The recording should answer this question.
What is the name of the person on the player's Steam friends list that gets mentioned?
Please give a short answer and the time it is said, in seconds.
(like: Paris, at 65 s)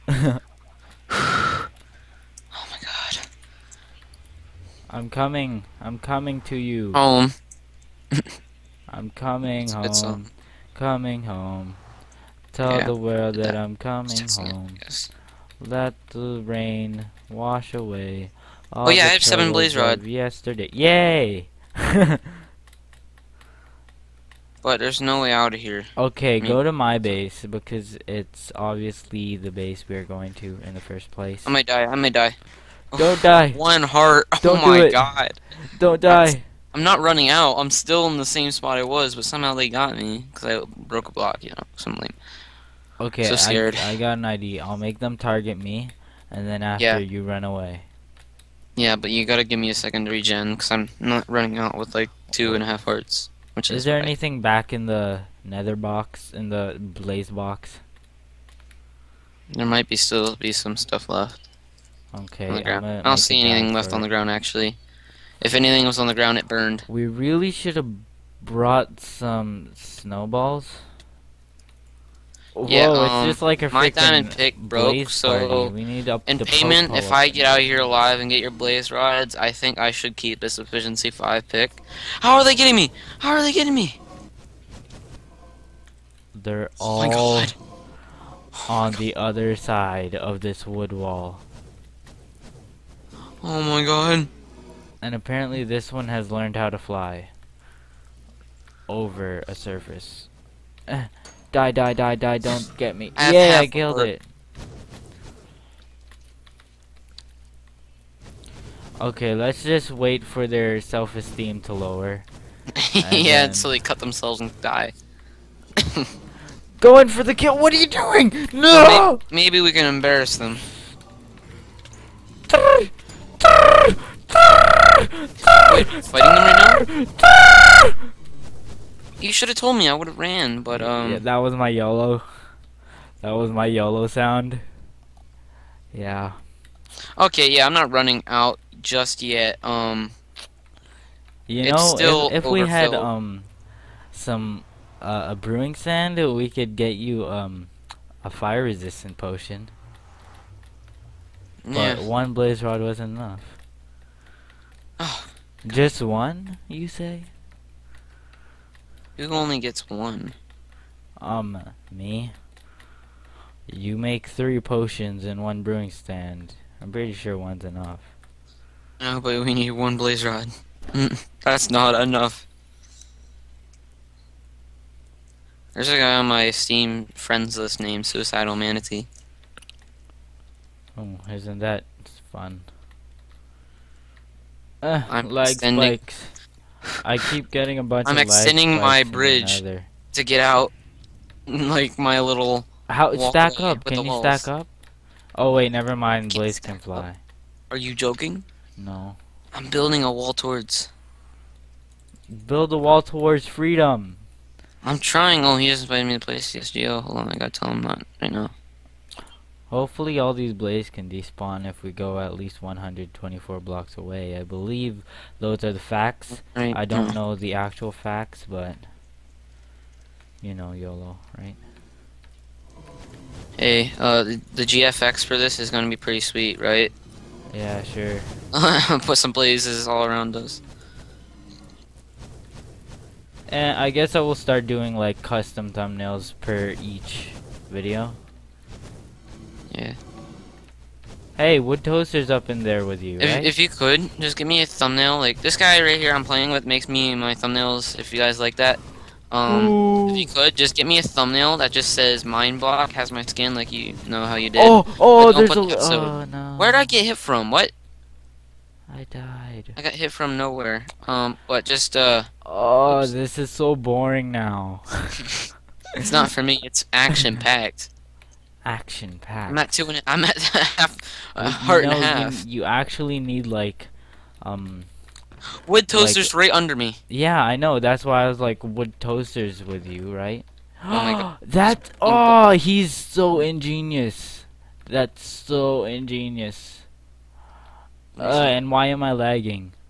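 Suicidal Manatee, at 178 s.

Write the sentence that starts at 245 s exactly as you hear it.
Like, this guy right here I'm playing with makes me my thumbnails, if you guys like that.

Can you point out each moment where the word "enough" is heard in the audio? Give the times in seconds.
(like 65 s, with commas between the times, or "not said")
153 s, 167 s, 172 s.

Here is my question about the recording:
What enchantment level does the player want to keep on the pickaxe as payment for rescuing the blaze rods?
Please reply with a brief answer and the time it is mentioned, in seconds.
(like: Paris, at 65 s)
efficiency 5, at 80 s.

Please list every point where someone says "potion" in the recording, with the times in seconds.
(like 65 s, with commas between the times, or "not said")
149 s, 164 s.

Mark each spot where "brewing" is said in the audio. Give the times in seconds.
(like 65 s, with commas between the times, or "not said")
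145 s, 165 s.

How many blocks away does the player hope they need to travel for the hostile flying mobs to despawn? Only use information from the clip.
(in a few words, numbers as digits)
124.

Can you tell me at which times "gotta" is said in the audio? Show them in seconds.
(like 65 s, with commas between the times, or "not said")
49 s, 207 s.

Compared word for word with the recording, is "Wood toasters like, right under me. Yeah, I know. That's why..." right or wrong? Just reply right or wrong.
right.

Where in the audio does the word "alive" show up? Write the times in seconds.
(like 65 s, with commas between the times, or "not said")
77 s.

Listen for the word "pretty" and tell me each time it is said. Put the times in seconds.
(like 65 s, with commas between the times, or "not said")
166 s, 225 s.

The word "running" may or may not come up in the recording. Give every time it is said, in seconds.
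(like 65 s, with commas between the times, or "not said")
36 s, 51 s, 137 s.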